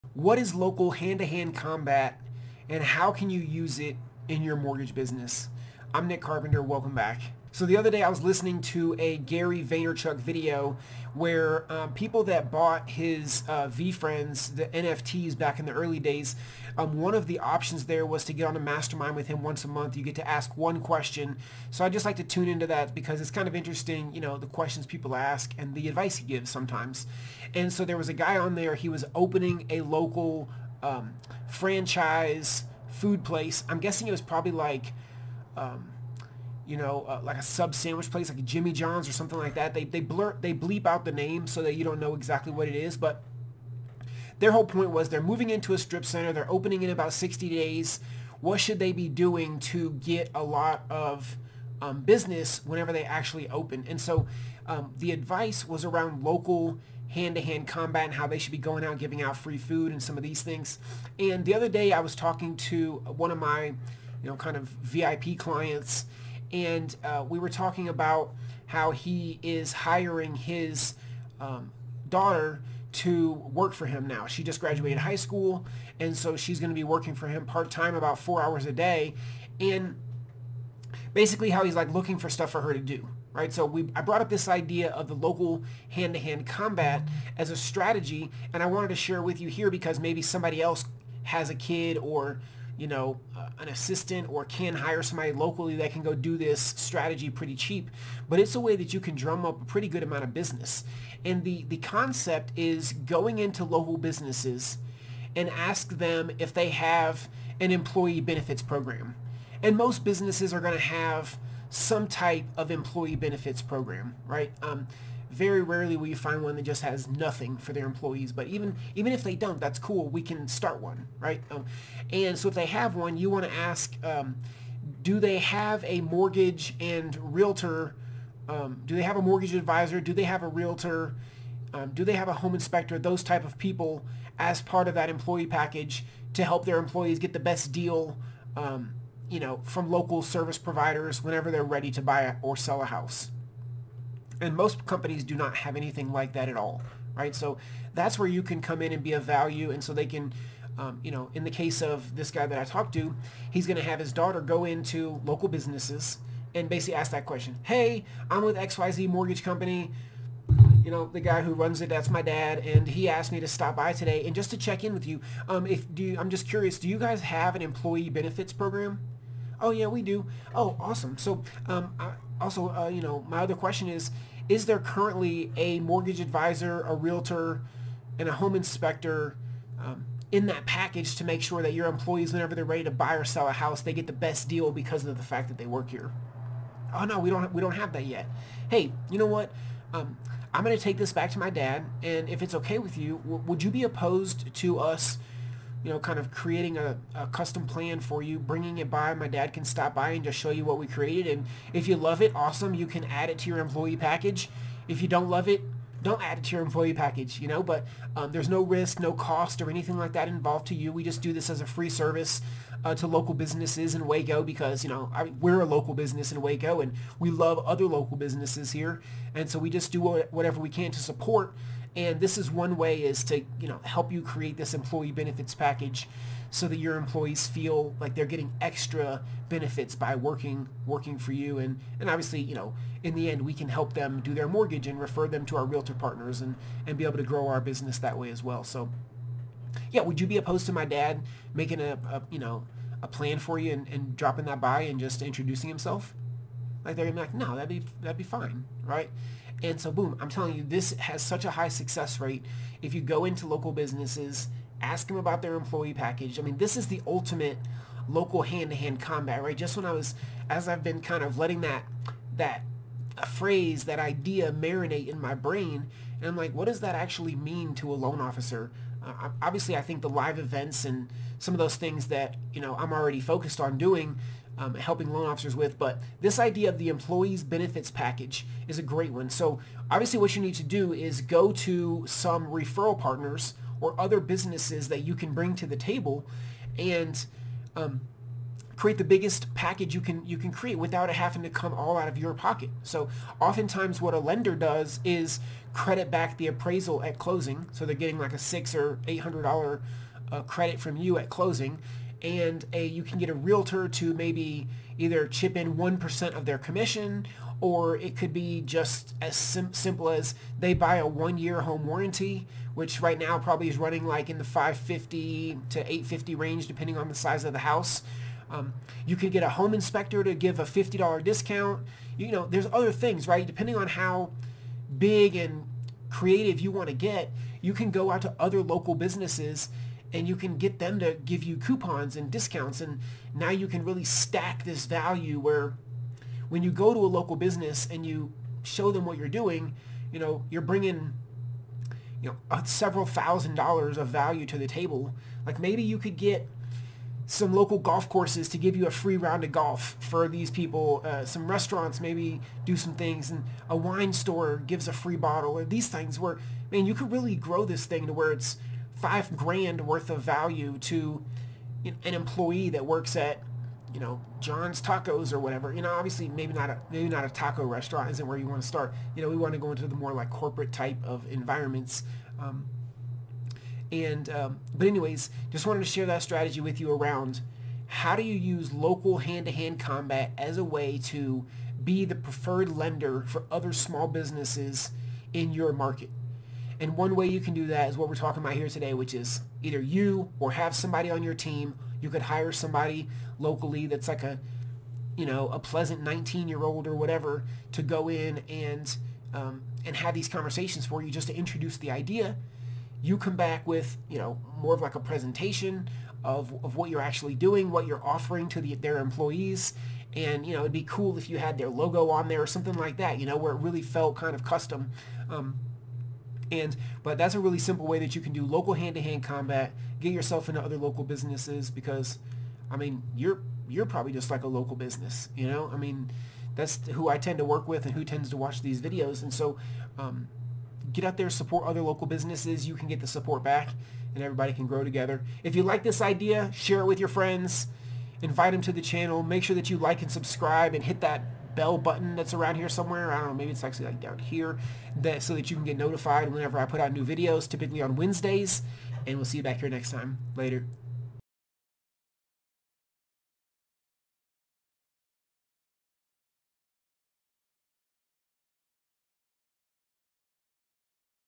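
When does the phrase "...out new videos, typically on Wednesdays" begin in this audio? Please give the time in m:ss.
7:26.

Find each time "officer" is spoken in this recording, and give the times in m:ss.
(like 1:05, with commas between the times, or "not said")
4:28, 4:35.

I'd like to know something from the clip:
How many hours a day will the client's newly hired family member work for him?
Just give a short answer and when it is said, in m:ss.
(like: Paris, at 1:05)
4, at 1:18.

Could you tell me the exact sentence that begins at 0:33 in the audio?
I'm guessing it was probably like...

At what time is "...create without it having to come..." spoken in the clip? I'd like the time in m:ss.
4:50.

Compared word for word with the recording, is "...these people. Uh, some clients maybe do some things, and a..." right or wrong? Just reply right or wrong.
wrong.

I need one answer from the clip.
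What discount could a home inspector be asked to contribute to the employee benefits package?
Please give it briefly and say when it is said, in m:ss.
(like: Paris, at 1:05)
$50, at 5:20.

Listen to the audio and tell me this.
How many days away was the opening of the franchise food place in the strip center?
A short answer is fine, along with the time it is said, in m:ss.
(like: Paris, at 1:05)
60, at 0:47.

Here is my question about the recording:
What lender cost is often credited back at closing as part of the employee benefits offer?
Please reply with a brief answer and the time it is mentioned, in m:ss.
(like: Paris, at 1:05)
The appraisal, at 4:56.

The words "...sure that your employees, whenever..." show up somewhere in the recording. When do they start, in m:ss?
3:01.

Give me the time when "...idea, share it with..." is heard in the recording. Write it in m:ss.
7:16.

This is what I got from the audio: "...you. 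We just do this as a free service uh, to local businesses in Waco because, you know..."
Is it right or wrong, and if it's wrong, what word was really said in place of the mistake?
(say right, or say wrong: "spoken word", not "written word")
right.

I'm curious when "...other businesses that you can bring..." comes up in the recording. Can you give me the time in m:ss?
4:43.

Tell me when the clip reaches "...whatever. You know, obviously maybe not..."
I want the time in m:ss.
6:05.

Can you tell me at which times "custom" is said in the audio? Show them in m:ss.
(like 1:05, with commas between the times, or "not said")
3:17, 6:54.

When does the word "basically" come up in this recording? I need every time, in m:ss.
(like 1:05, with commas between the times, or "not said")
1:21, 2:36.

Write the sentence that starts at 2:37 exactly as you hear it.
Hey, I'm with XYZ Mortgage Company.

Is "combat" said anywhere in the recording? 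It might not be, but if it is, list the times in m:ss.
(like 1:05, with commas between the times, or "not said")
0:01, 0:57, 1:26, 4:18, 6:19, 6:59.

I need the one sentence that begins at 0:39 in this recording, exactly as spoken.
They they blurt they bleep out the name so that you don't know exactly what it is.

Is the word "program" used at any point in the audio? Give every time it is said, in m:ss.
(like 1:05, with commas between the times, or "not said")
1:48, 1:53, 2:48.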